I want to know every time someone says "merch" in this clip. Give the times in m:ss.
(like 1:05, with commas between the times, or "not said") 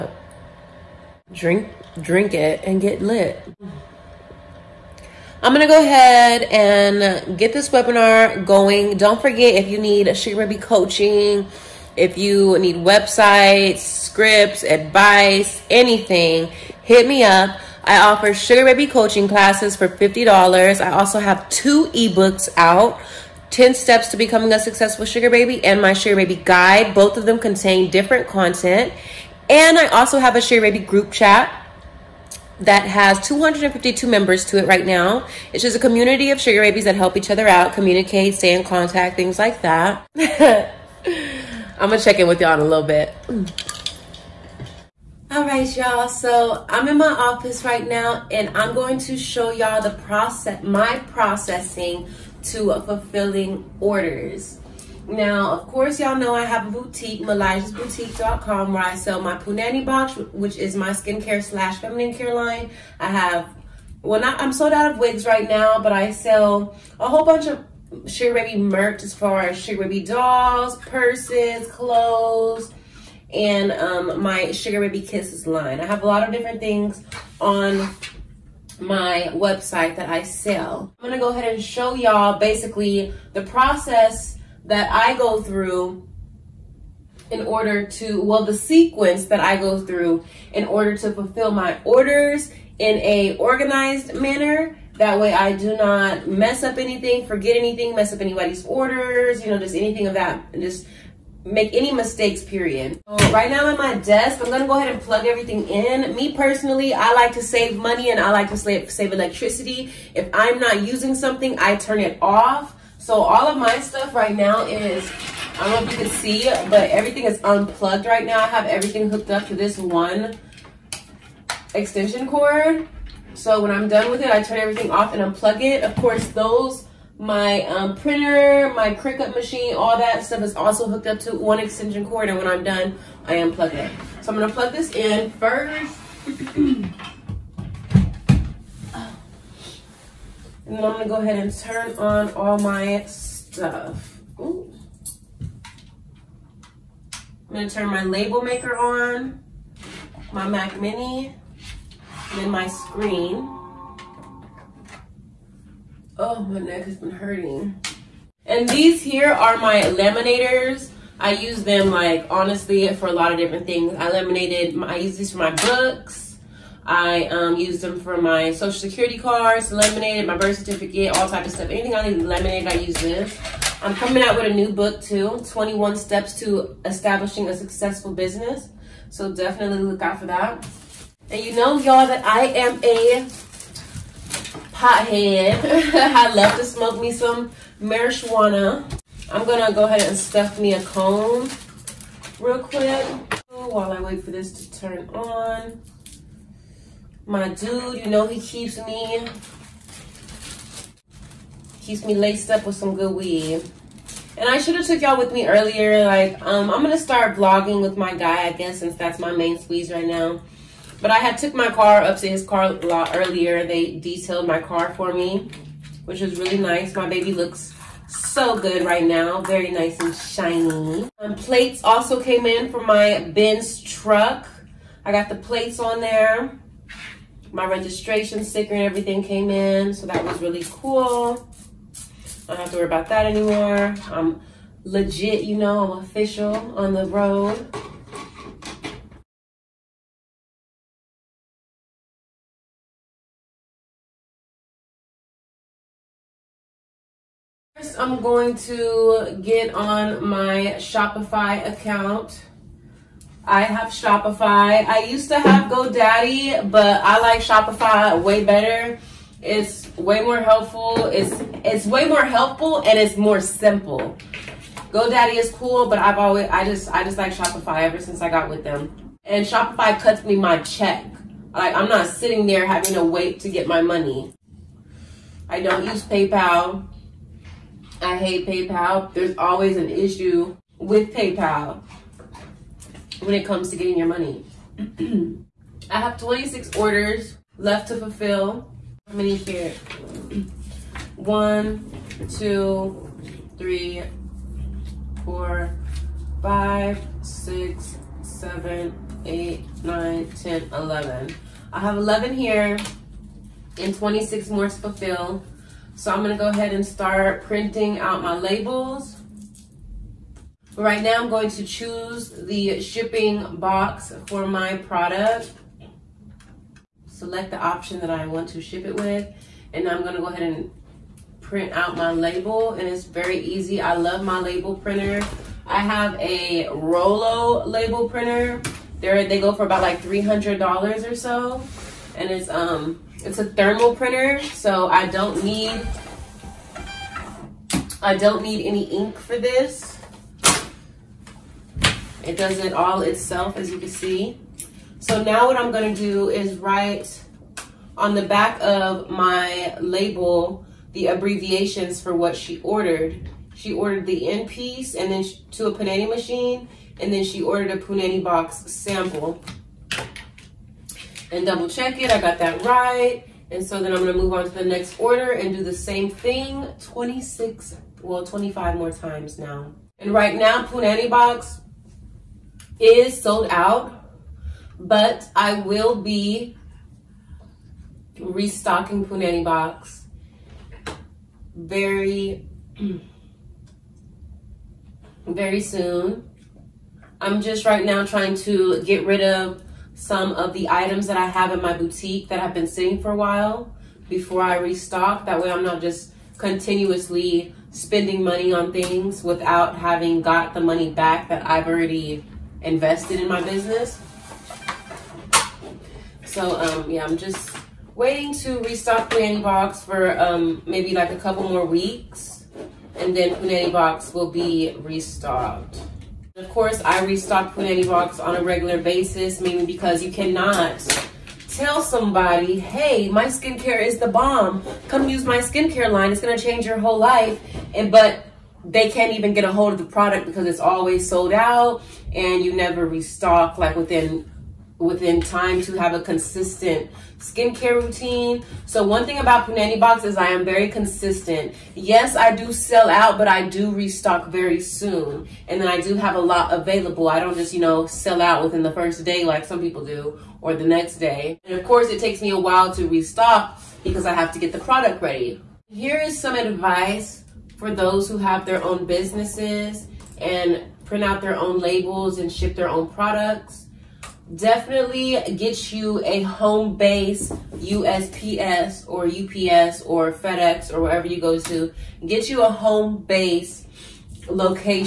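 1:08.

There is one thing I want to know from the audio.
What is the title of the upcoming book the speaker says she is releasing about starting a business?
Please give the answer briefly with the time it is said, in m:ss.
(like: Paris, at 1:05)
21 Steps to Establishing a Successful Business, at 2:55.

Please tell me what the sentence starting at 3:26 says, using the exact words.
Like, um, I'm gonna start vlogging with my guy, I guess, since that's my main squeeze right now.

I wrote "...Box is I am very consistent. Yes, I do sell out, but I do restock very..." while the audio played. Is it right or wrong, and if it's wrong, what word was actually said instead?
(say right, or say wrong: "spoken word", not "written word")
right.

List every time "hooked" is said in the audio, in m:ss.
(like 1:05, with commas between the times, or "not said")
1:59, 2:10.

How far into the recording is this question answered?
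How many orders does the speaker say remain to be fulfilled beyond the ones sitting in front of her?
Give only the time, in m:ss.
5:03.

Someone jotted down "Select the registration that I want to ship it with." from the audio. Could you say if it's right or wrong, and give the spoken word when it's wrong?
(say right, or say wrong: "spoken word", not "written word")
wrong: "option", not "registration".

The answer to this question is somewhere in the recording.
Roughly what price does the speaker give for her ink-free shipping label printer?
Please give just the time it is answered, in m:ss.
5:29.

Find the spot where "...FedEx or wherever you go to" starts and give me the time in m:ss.
7:50.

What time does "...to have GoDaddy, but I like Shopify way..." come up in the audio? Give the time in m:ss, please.
4:15.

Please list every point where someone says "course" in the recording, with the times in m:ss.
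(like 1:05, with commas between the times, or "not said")
0:55, 2:05, 6:56, 7:31.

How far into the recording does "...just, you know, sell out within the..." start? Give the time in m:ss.
7:27.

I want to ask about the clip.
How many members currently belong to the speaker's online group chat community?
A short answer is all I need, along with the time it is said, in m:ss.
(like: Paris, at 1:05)
252, at 0:33.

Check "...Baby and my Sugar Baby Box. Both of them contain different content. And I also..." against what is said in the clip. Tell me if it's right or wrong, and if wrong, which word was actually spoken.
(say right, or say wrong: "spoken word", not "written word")
wrong: "Guide", not "Box".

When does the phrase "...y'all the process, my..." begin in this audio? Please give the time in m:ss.
0:49.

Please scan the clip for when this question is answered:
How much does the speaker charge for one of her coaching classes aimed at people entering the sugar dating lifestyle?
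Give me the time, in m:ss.
0:19.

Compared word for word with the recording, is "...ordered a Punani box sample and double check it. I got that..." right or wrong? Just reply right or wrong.
right.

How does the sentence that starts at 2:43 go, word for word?
I laminated, my, I use these for my books.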